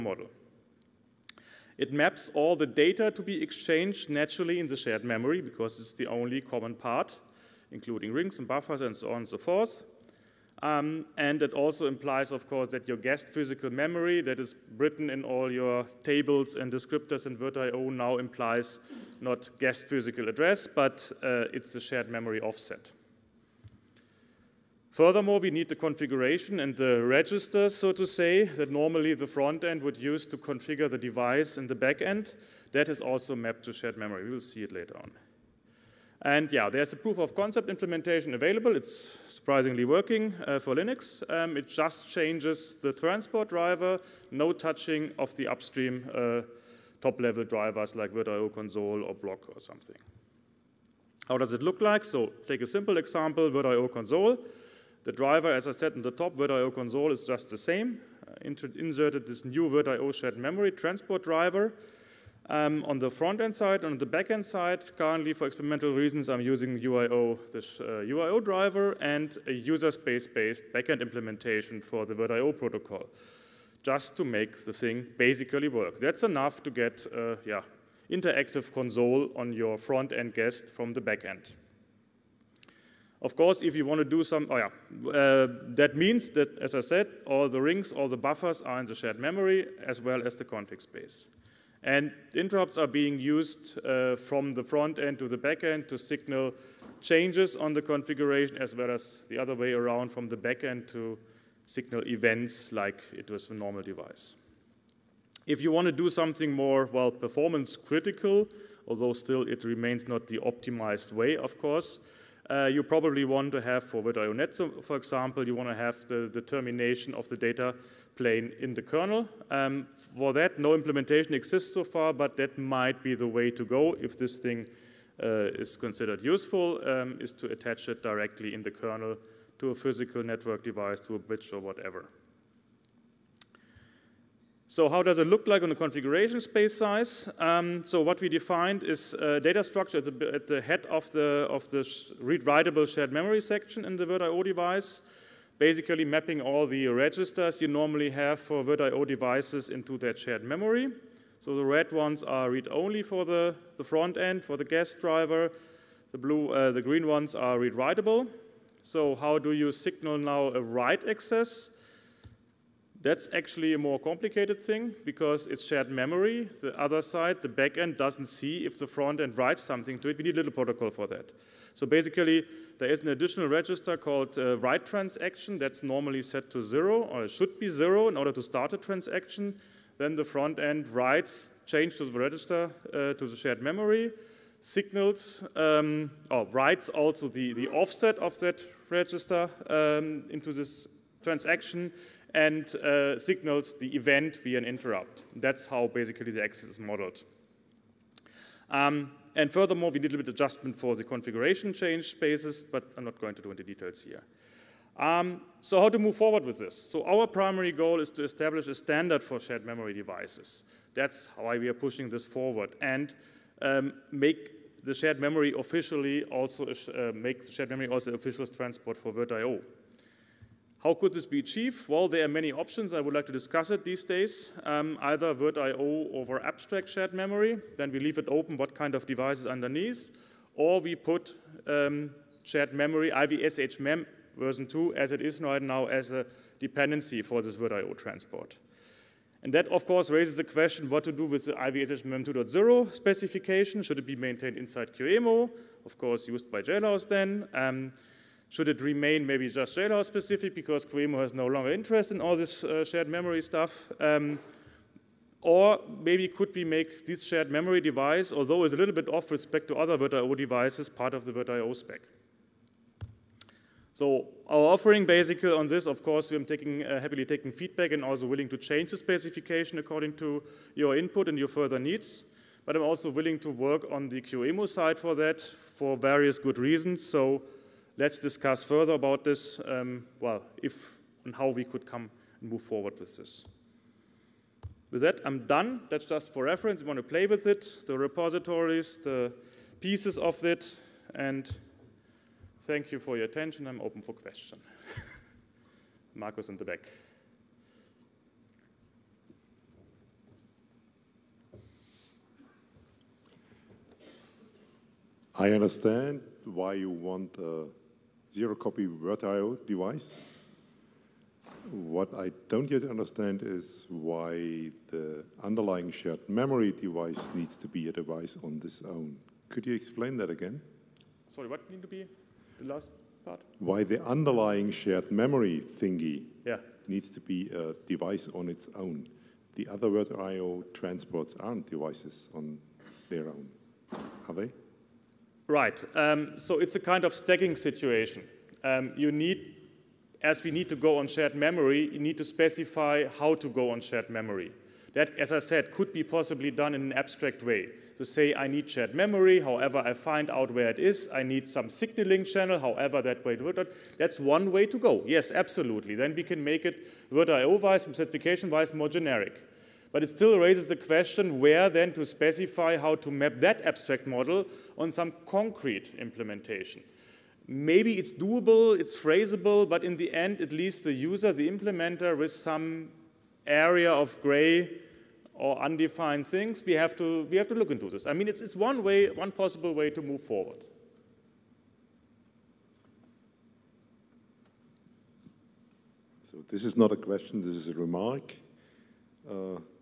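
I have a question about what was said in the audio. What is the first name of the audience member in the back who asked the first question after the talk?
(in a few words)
Marcus.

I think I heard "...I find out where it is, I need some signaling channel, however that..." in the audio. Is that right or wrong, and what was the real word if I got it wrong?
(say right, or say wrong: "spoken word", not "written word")
right.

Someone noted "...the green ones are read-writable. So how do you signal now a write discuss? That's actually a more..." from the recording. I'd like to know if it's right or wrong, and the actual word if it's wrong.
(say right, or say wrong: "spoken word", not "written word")
wrong: "access", not "discuss".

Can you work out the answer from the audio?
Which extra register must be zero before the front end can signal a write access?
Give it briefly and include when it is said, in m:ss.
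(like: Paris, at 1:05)
write transaction, at 2:54.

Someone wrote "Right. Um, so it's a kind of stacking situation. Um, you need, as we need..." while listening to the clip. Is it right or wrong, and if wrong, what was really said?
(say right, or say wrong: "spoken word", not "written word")
right.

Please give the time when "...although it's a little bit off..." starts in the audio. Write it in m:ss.
4:18.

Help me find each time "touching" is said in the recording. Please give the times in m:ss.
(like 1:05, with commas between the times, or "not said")
0:44.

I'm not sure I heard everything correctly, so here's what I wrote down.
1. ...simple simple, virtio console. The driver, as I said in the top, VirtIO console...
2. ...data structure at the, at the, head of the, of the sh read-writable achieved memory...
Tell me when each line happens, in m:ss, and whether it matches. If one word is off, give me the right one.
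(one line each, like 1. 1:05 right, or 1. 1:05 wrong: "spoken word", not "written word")
1. 0:52 wrong: "example", not "simple"
2. 2:19 wrong: "shared", not "achieved".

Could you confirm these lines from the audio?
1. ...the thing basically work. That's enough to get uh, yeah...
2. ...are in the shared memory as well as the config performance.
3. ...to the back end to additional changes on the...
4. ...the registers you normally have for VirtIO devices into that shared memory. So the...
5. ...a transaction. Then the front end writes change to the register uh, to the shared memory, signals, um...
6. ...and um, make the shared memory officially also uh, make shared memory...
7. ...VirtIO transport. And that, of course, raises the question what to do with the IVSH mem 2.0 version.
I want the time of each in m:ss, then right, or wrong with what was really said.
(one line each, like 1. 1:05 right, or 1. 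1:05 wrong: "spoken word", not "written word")
1. 1:14 right
2. 1:28 wrong: "space", not "performance"
3. 1:35 wrong: "signal", not "additional"
4. 2:26 right
5. 2:58 right
6. 3:32 right
7. 3:57 wrong: "specification", not "version".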